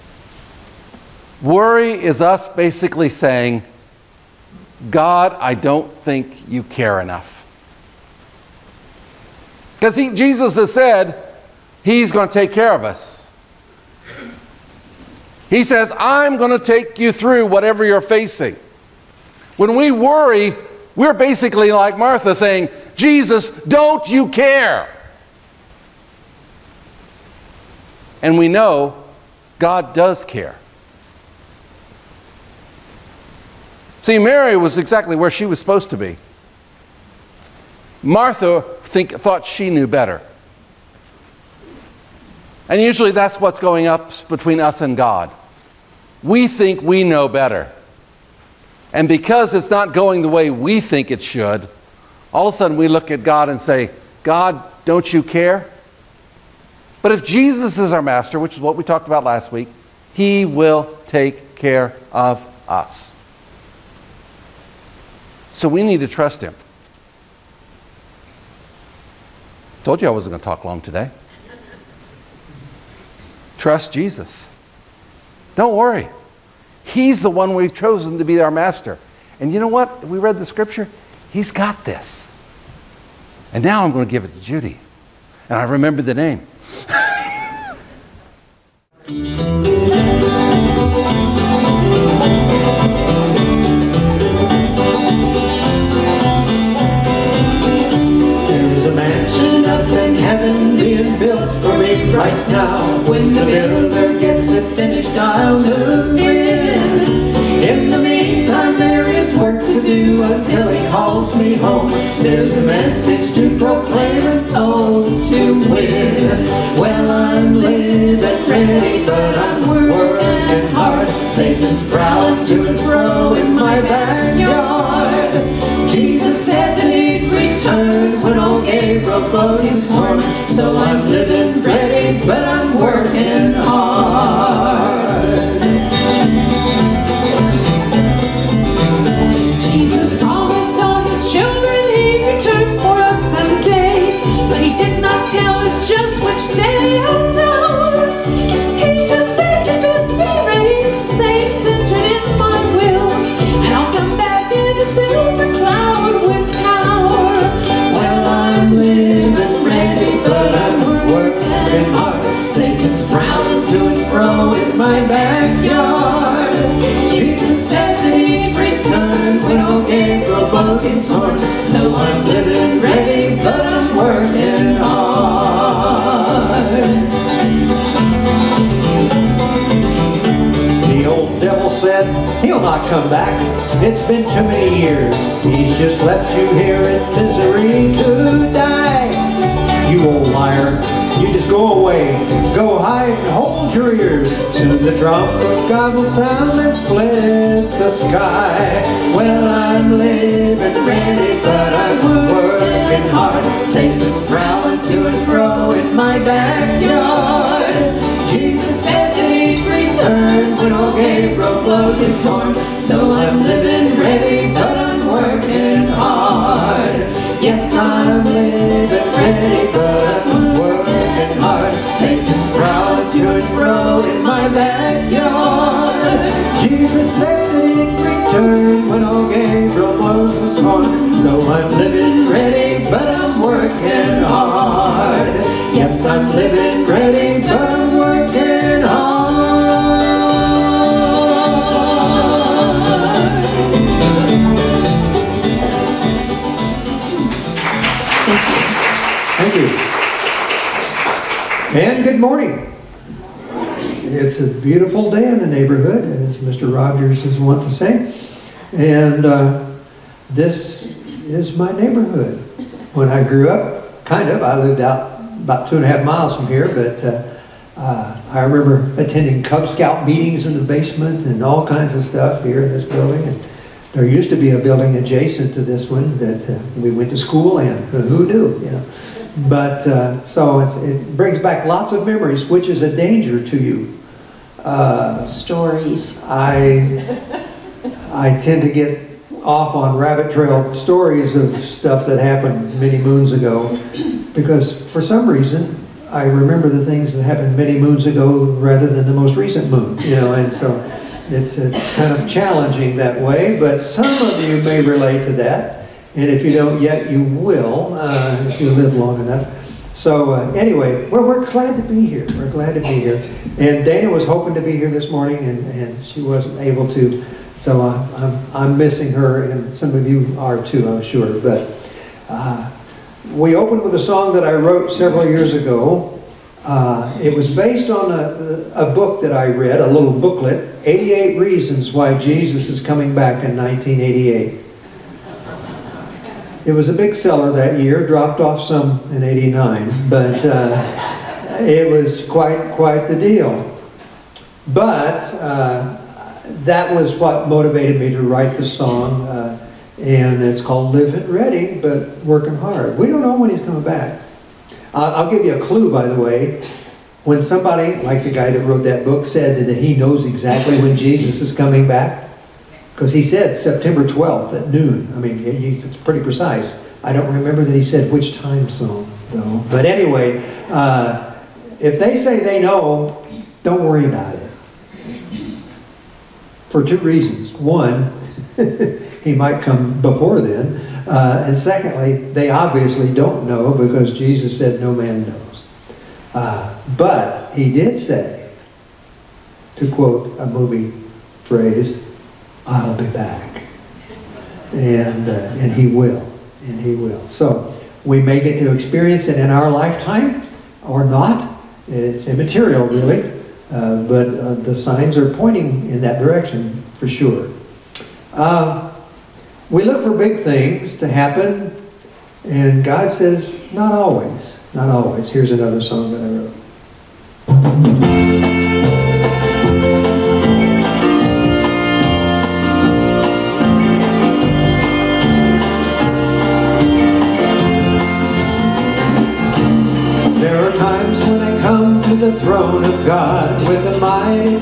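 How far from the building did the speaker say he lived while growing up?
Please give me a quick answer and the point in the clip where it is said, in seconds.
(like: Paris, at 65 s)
2.5 miles, at 265 s.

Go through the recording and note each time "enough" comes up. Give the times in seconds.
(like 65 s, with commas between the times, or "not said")
7 s, 309 s.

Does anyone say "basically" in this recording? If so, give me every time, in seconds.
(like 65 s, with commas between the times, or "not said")
2 s, 21 s.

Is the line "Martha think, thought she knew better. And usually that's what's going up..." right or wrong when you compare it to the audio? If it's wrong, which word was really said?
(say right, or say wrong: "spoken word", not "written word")
right.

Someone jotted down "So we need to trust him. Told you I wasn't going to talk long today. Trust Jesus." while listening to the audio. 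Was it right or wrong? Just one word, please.
right.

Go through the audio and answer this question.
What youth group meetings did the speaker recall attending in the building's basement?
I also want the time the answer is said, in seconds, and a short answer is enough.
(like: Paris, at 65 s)
Cub Scout, at 269 s.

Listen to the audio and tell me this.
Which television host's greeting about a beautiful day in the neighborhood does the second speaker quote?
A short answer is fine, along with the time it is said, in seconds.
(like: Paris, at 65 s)
Mr. Rogers, at 256 s.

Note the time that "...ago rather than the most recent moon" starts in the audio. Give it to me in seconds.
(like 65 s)
298 s.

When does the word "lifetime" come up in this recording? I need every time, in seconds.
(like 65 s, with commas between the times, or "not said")
399 s.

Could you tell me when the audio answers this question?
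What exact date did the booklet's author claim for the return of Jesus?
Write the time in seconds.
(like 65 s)
363 s.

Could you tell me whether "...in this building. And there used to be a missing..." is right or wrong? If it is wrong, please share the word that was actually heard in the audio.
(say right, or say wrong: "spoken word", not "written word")
wrong: "building", not "missing".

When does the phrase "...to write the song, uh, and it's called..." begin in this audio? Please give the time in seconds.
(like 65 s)
348 s.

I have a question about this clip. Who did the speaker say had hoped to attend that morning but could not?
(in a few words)
Dana.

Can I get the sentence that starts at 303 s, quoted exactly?
But some of you may relate to that.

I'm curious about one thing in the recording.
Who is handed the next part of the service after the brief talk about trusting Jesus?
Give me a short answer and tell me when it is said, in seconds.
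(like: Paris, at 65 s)
Judy, at 84 s.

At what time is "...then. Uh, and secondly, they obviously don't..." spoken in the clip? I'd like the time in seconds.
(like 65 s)
380 s.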